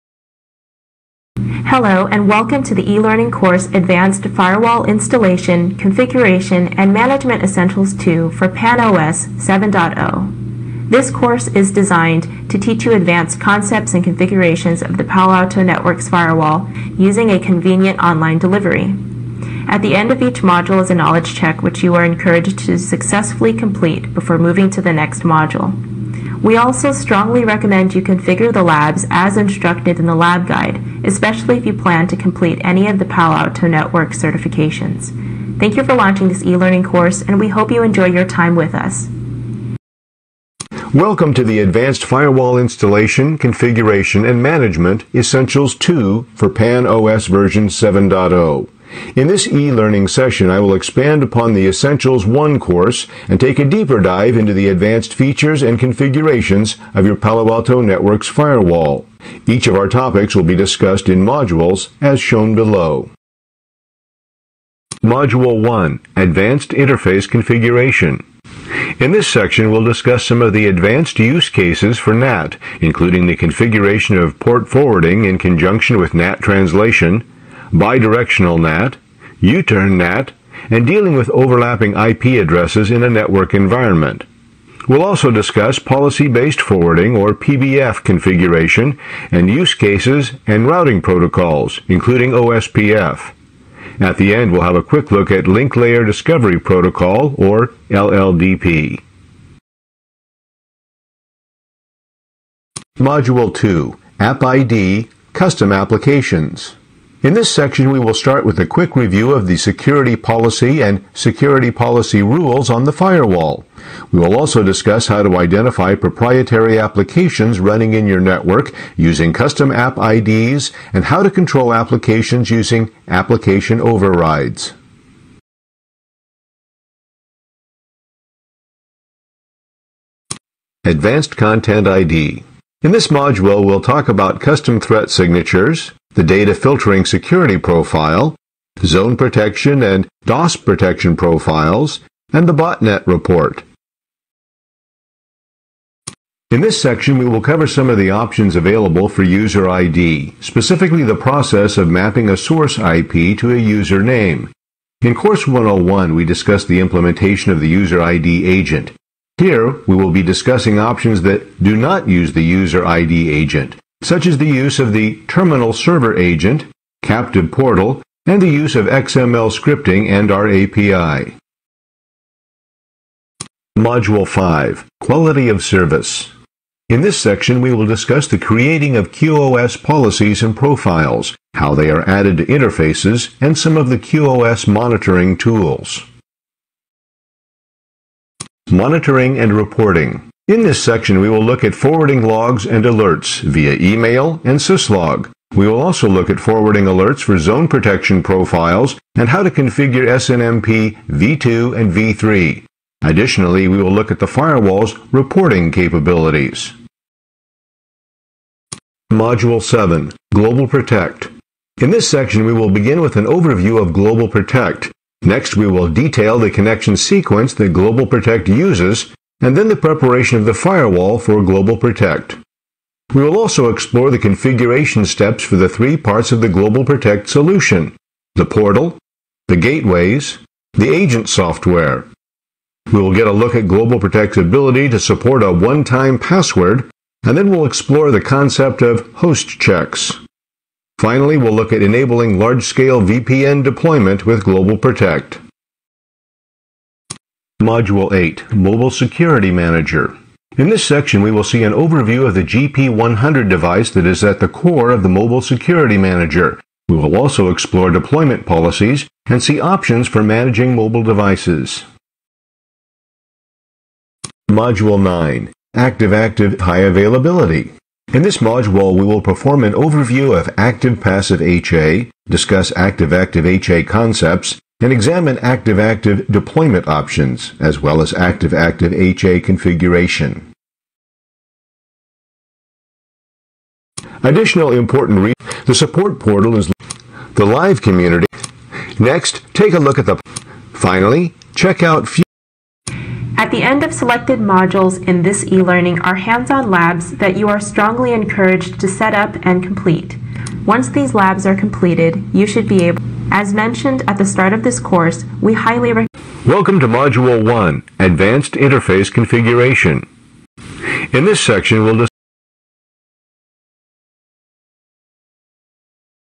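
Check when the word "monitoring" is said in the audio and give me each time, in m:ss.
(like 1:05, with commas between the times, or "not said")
3:04, 3:08.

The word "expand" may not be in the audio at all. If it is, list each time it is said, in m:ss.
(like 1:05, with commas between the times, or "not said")
0:50.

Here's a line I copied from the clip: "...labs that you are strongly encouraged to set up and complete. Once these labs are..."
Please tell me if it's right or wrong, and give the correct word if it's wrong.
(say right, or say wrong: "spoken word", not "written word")
right.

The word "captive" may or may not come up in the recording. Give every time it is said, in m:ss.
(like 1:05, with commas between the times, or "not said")
2:47.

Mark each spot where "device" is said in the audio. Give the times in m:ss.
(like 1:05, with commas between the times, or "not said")
4:13, 4:21.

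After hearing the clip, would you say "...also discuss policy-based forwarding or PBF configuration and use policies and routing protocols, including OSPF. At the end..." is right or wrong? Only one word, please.
wrong.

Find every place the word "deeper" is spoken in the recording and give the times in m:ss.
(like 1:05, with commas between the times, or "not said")
0:53.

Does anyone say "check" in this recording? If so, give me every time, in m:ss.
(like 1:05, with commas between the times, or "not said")
0:21, 3:59, 4:51.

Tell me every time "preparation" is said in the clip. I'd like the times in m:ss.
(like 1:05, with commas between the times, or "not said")
3:39.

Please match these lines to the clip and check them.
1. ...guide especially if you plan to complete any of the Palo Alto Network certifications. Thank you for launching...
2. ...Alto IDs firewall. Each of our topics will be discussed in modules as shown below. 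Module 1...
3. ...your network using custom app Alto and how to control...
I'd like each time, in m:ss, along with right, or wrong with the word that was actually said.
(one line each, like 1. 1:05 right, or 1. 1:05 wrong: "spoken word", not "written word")
1. 0:30 right
2. 0:57 wrong: "Networks", not "IDs"
3. 1:58 wrong: "IDs", not "Alto".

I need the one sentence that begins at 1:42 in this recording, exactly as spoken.
Module 2, App ID, Custom Applications.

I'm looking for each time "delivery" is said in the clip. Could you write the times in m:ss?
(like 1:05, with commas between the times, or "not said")
0:18.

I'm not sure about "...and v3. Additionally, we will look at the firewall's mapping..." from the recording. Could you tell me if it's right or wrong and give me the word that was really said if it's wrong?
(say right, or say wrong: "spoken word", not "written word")
wrong: "reporting", not "mapping".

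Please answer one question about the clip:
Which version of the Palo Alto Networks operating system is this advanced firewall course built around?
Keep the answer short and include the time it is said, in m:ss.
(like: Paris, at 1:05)
PAN-OS 7.0, at 0:08.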